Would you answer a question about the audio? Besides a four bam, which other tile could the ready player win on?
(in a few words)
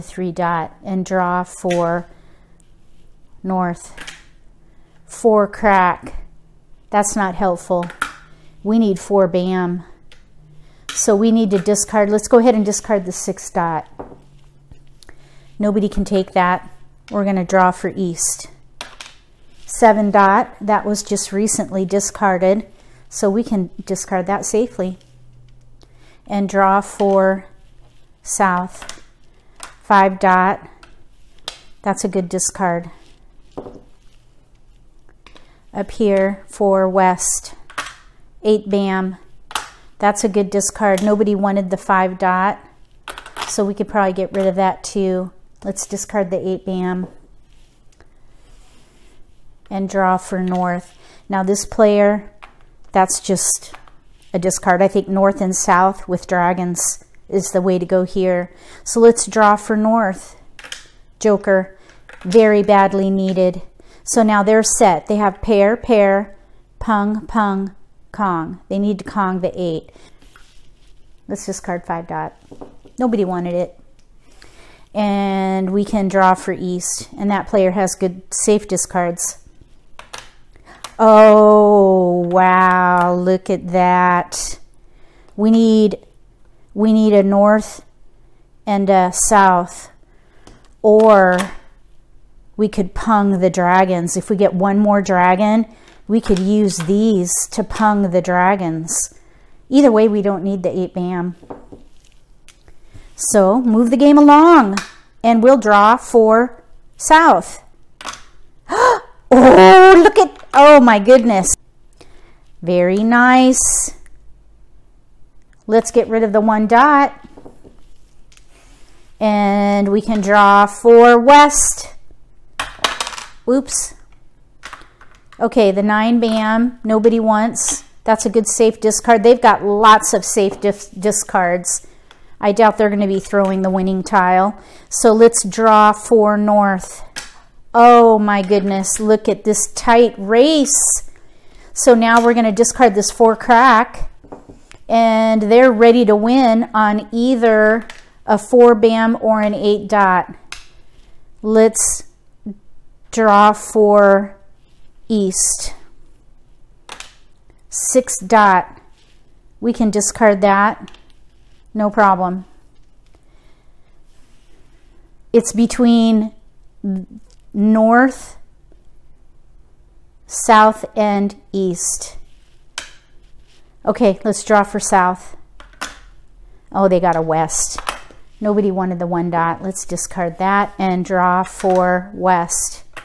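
eight dot.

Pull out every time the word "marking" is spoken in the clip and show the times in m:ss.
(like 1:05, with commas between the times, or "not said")
not said.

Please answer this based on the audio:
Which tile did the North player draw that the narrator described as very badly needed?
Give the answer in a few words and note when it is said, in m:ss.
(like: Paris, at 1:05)
Joker, at 1:01.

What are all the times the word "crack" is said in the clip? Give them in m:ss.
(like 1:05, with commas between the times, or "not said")
0:05, 2:23.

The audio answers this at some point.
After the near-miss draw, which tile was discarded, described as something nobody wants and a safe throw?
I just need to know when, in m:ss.
2:05.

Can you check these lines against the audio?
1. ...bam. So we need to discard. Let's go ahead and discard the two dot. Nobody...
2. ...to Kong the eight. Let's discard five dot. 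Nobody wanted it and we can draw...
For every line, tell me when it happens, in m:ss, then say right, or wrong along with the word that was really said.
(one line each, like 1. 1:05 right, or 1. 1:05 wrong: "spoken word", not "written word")
1. 0:09 wrong: "six", not "two"
2. 1:08 right.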